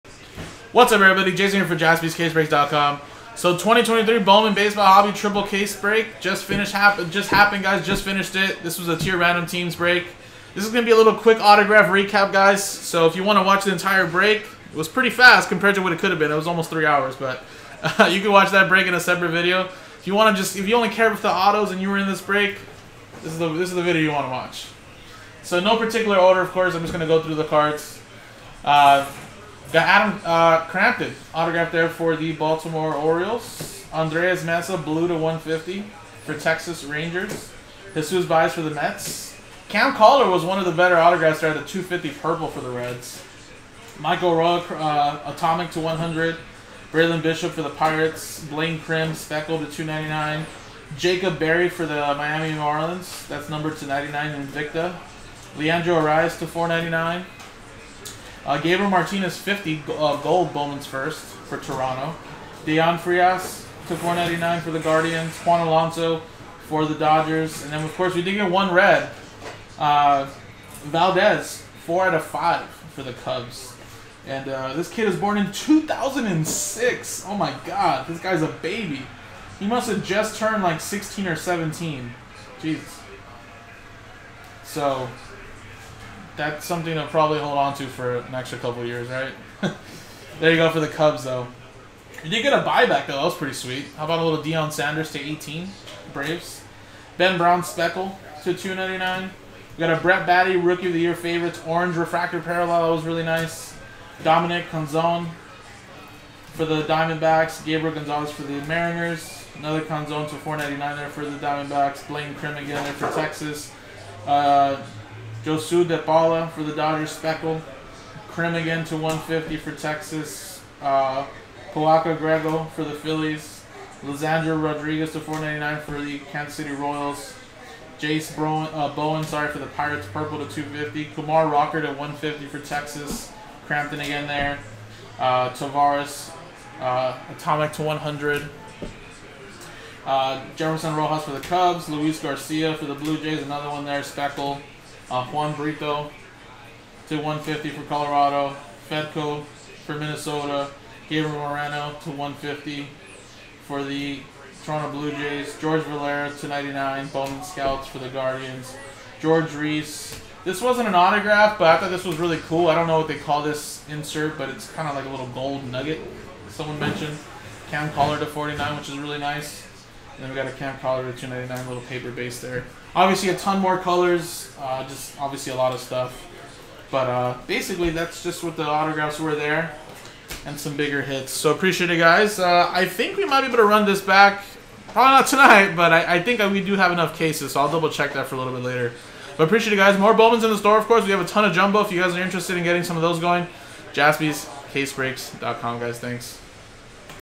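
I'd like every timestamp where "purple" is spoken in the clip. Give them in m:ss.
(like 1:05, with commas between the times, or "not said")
0:42, 2:10.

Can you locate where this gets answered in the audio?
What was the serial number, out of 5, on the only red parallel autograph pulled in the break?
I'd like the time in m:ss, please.
1:11.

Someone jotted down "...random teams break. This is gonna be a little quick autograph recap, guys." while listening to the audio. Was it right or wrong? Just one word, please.
right.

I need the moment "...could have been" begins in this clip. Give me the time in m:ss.
0:15.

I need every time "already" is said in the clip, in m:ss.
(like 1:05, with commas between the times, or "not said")
not said.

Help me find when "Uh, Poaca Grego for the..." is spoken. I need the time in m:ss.
2:00.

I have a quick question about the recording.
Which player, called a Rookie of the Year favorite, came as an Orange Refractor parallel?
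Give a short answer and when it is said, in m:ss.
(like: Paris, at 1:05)
Brett Baty, at 1:40.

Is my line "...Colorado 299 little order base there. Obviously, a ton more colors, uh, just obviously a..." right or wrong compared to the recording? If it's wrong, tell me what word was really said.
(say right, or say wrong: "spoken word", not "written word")
wrong: "paper", not "order".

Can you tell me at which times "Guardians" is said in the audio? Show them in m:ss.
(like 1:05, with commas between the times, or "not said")
1:04, 2:38.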